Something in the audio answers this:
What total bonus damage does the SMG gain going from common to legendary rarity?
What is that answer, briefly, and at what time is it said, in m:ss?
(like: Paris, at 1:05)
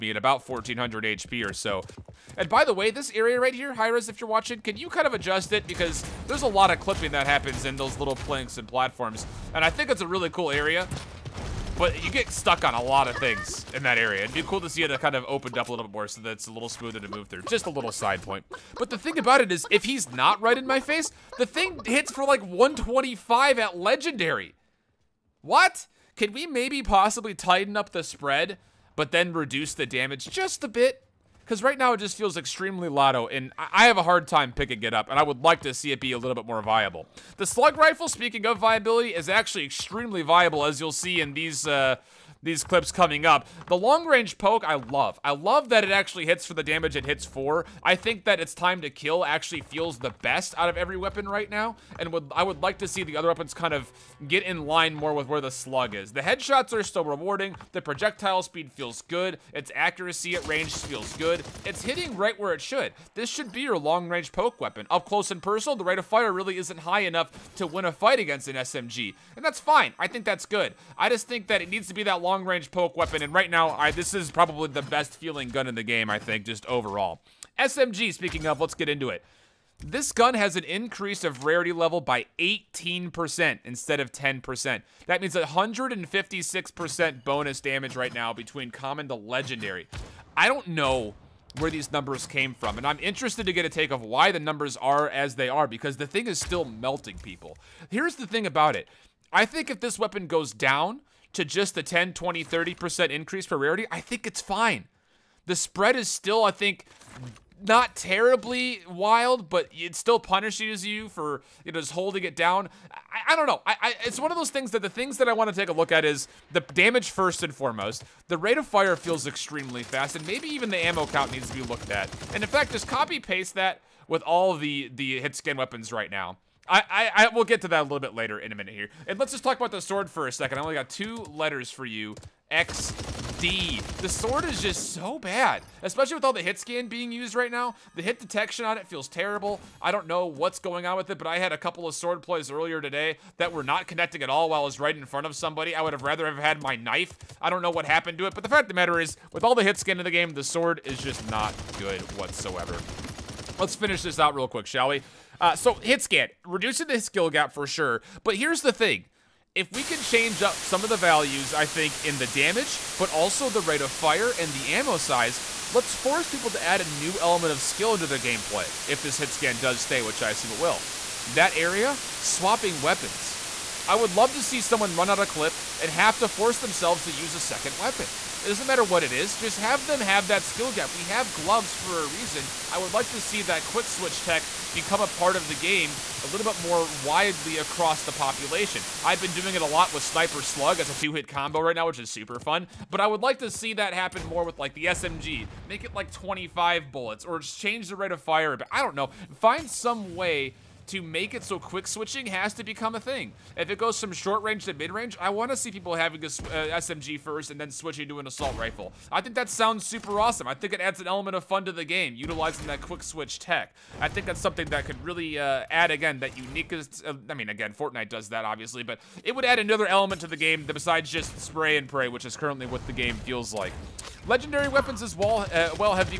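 156%, at 1:25.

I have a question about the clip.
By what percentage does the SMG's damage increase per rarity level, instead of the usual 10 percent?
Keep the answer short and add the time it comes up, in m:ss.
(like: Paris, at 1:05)
18%, at 1:22.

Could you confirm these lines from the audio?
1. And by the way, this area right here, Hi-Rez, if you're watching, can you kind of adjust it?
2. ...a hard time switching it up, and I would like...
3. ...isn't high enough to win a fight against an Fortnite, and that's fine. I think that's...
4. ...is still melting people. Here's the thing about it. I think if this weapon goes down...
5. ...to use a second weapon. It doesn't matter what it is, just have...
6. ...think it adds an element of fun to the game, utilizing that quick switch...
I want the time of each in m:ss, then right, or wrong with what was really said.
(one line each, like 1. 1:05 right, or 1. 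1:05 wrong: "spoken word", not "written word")
1. 0:02 right
2. 0:33 wrong: "picking", not "switching"
3. 1:06 wrong: "SMG", not "Fortnite"
4. 1:36 right
5. 2:57 right
6. 3:30 right.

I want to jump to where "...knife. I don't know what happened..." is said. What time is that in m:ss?
2:26.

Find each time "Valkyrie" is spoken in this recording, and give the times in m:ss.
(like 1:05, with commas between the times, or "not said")
not said.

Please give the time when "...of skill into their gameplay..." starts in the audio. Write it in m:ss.
2:47.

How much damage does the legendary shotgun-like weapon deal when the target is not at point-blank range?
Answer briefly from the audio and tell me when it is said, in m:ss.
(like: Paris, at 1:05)
125, at 0:22.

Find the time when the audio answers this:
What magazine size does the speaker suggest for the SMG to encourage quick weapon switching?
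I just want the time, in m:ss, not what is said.
3:16.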